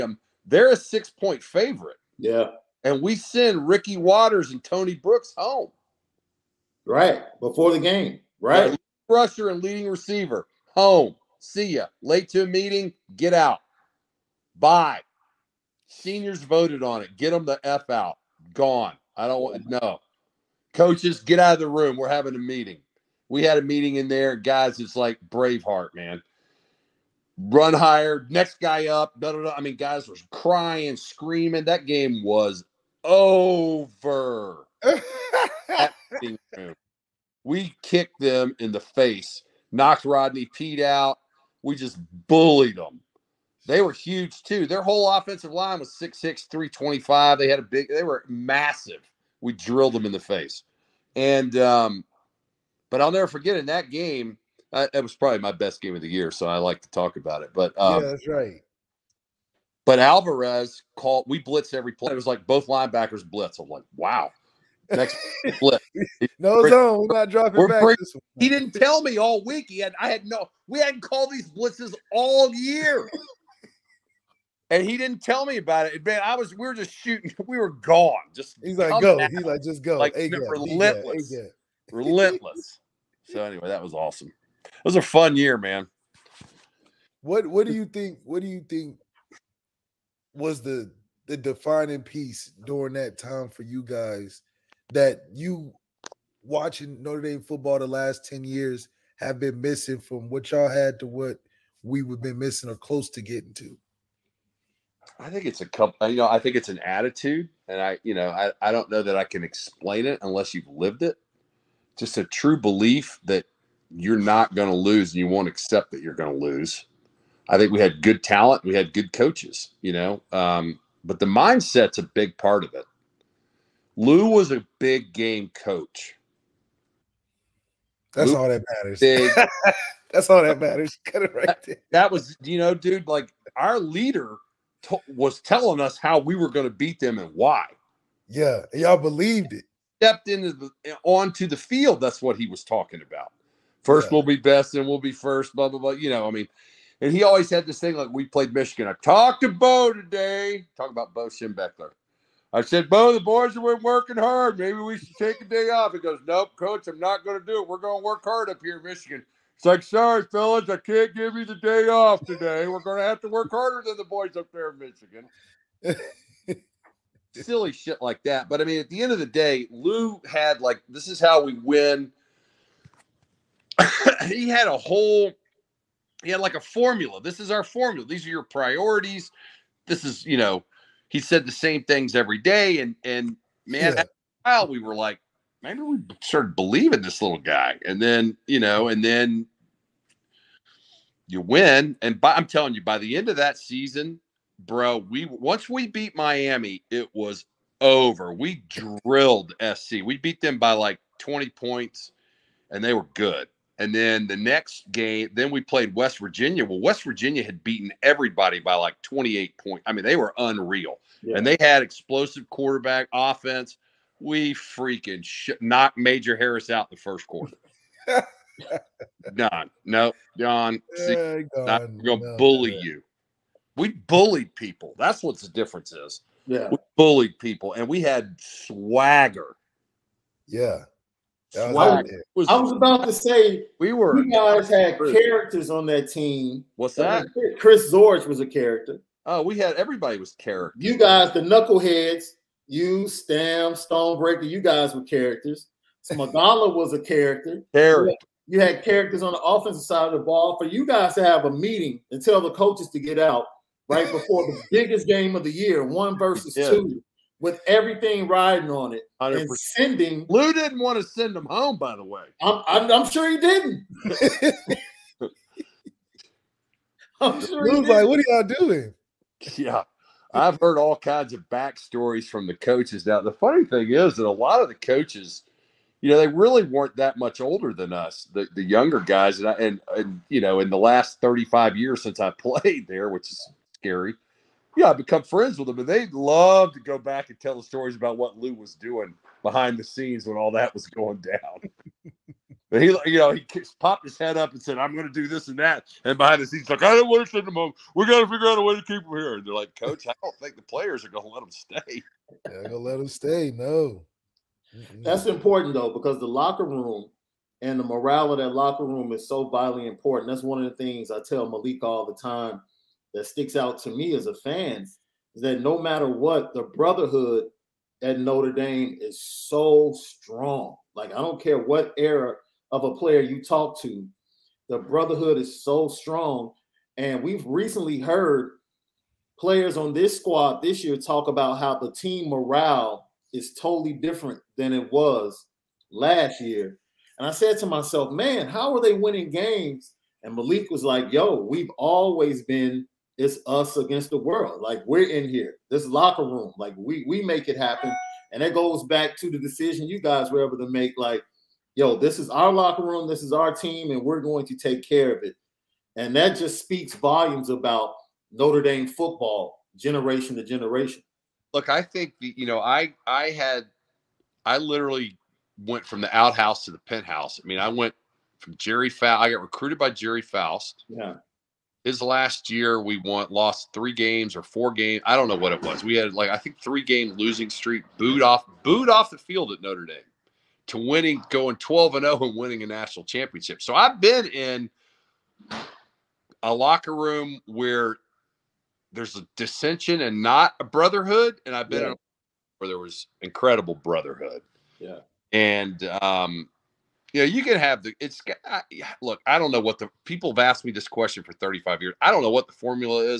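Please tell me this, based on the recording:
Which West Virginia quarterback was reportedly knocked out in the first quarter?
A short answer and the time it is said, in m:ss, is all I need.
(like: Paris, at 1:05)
Major Harris, at 3:35.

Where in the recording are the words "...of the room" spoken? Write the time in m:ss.
0:21.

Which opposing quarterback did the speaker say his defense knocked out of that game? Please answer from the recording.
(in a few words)
Rodney Peete.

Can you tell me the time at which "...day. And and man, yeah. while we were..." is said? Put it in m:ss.
3:02.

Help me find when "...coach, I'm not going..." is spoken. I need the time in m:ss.
2:36.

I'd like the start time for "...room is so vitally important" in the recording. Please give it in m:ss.
5:08.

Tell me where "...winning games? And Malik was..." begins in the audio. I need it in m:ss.
5:38.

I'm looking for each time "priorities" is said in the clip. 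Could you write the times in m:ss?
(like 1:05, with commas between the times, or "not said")
2:58.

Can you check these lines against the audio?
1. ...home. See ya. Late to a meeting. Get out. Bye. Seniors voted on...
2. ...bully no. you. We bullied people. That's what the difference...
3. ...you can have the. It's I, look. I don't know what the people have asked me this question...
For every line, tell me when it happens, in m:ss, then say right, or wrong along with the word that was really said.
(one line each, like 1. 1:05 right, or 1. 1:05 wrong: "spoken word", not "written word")
1. 0:10 right
2. 3:42 right
3. 6:37 right.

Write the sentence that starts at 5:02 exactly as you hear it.
They're going to let them stay.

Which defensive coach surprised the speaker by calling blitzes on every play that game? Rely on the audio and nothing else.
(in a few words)
Alvarez.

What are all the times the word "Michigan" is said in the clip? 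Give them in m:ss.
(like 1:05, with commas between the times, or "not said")
2:28, 2:38, 2:44.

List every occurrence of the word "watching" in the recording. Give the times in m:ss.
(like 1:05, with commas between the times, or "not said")
1:36.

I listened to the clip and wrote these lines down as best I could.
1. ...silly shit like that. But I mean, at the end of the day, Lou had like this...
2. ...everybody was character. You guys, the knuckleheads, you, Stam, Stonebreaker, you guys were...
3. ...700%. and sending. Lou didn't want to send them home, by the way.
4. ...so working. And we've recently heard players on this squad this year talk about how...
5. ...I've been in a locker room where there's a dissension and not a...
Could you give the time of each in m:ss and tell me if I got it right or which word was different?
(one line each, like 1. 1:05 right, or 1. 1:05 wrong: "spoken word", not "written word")
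1. 2:47 right
2. 3:59 right
3. 4:19 wrong: "100", not "700"
4. 5:25 wrong: "strong", not "working"
5. 6:23 right.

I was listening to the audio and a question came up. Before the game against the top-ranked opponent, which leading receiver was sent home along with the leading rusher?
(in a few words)
Tony Brooks.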